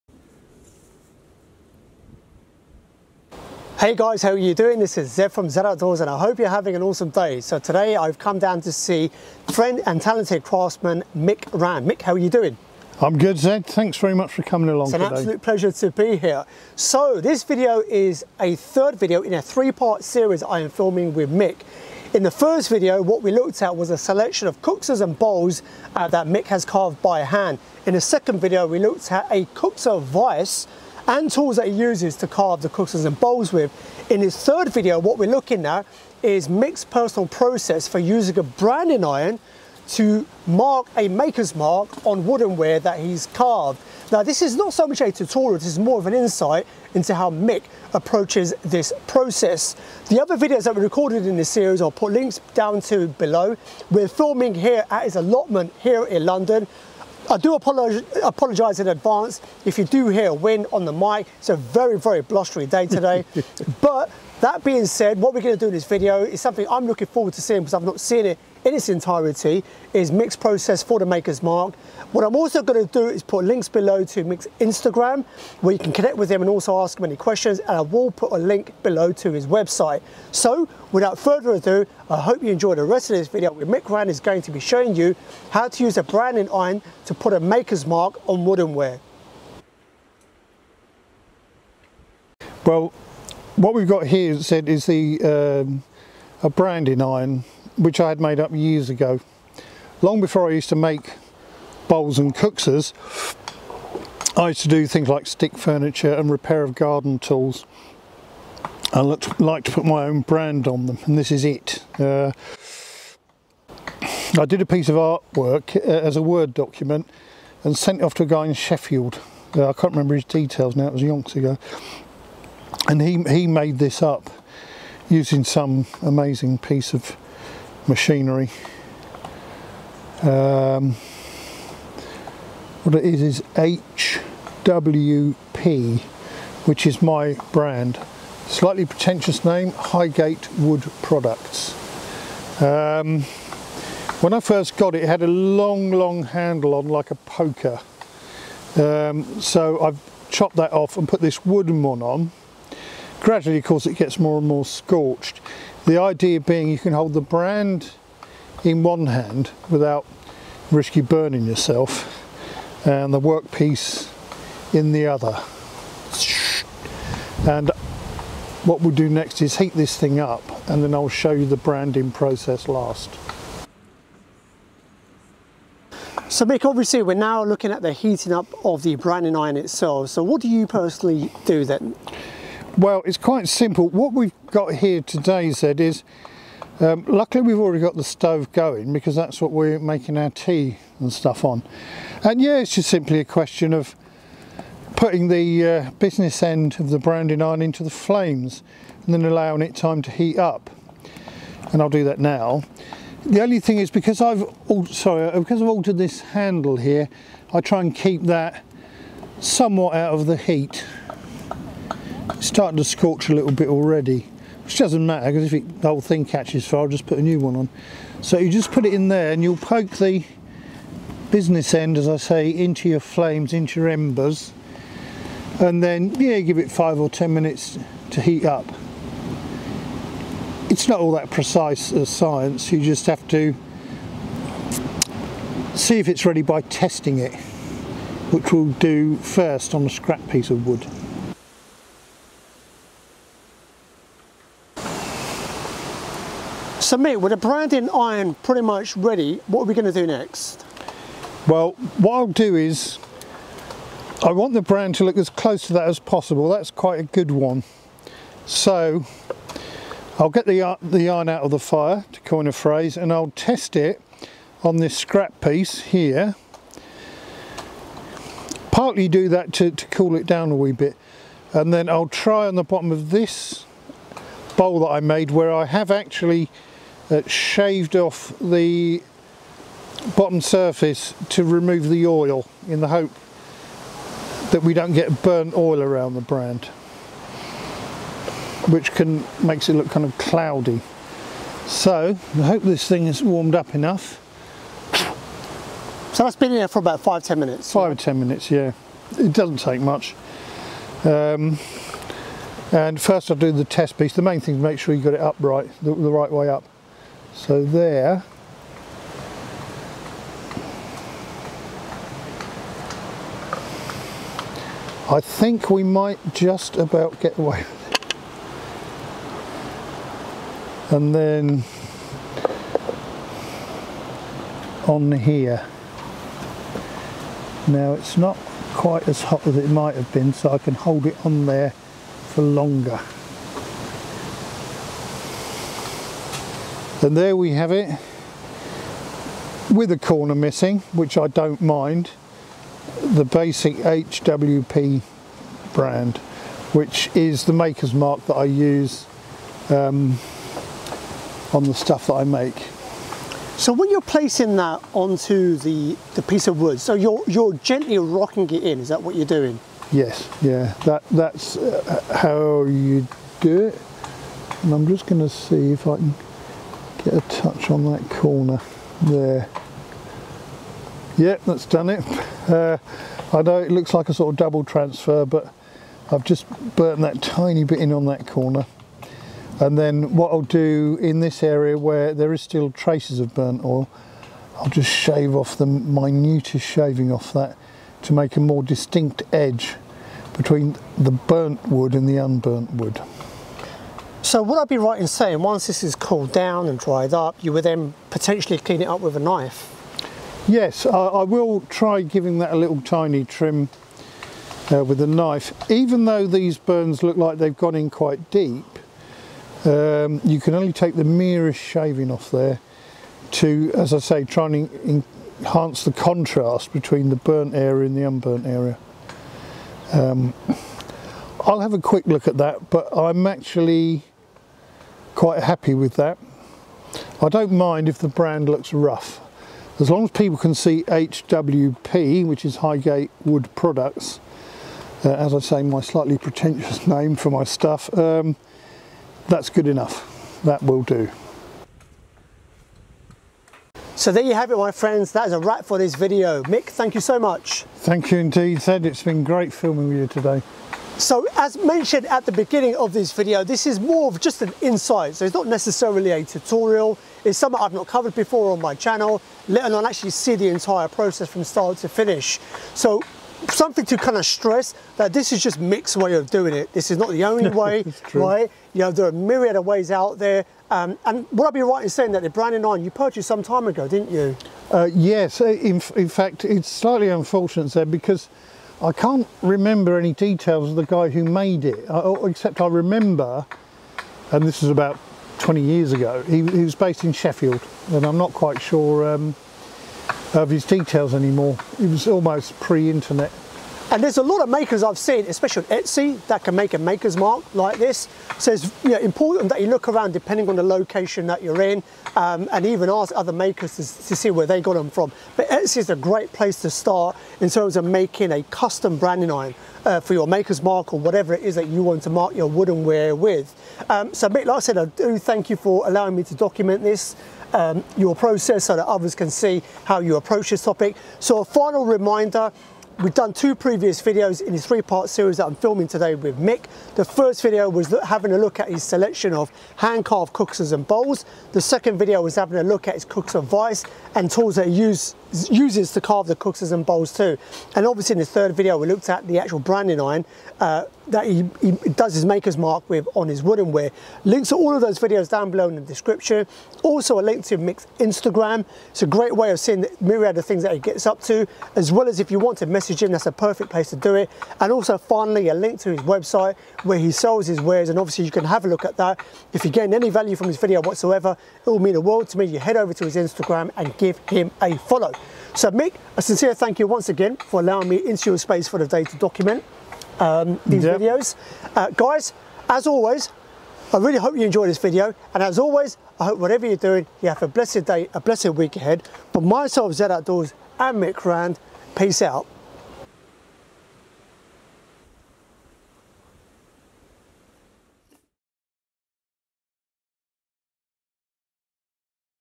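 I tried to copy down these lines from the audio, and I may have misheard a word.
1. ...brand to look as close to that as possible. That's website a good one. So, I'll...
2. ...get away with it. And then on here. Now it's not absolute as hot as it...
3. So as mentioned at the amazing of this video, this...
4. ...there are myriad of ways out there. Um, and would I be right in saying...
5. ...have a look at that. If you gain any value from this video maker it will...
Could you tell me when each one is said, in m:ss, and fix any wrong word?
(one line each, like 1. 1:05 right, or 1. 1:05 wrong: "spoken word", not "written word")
1. 4:14 wrong: "quite", not "website"
2. 5:17 wrong: "quite", not "absolute"
3. 7:30 wrong: "beginning", not "amazing"
4. 7:48 right
5. 9:18 wrong: "whatsoever", not "maker".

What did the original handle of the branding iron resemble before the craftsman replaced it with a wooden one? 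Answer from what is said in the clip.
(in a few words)
A poker.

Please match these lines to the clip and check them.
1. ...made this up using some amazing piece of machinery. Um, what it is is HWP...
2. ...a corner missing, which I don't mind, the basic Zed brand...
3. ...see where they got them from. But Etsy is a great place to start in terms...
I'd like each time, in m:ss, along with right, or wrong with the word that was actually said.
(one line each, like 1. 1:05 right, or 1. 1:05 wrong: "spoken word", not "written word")
1. 2:03 right
2. 5:39 wrong: "HWP", not "Zed"
3. 8:24 right.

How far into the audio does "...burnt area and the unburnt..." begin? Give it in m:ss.
6:57.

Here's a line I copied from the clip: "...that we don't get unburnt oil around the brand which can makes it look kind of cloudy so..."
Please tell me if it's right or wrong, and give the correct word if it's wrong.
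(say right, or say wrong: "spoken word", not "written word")
wrong: "burnt", not "unburnt".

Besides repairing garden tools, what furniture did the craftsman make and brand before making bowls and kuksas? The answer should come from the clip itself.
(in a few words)
Stick furniture.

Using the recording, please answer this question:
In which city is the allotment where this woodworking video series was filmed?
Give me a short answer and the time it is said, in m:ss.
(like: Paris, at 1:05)
London, at 0:56.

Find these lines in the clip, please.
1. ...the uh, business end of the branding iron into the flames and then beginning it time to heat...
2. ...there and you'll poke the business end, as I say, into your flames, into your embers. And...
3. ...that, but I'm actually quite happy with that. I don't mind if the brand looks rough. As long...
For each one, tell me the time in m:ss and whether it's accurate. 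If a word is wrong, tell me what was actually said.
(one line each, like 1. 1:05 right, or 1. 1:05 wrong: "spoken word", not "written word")
1. 3:15 wrong: "allowing", not "beginning"
2. 3:39 right
3. 7:02 right.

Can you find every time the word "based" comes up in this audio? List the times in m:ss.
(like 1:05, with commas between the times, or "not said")
8:06.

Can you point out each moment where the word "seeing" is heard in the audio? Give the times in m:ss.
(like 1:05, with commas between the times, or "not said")
1:07, 9:09.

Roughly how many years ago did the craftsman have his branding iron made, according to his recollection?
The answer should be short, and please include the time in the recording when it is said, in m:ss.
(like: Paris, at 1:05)
20, at 8:05.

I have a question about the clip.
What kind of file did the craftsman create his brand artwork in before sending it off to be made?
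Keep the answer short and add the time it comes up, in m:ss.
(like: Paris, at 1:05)
Word document, at 1:56.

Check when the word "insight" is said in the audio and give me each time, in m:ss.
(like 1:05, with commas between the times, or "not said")
0:46, 7:34.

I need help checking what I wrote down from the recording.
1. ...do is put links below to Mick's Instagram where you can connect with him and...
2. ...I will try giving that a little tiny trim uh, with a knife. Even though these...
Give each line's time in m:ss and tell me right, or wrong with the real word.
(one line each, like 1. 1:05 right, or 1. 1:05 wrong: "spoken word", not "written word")
1. 1:12 right
2. 6:40 right.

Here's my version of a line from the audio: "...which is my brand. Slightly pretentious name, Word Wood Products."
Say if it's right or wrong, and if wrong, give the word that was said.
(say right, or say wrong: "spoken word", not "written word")
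wrong: "Highgate", not "Word".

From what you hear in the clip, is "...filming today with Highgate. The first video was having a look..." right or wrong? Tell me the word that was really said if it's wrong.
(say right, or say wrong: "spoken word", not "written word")
wrong: "Mick", not "Highgate".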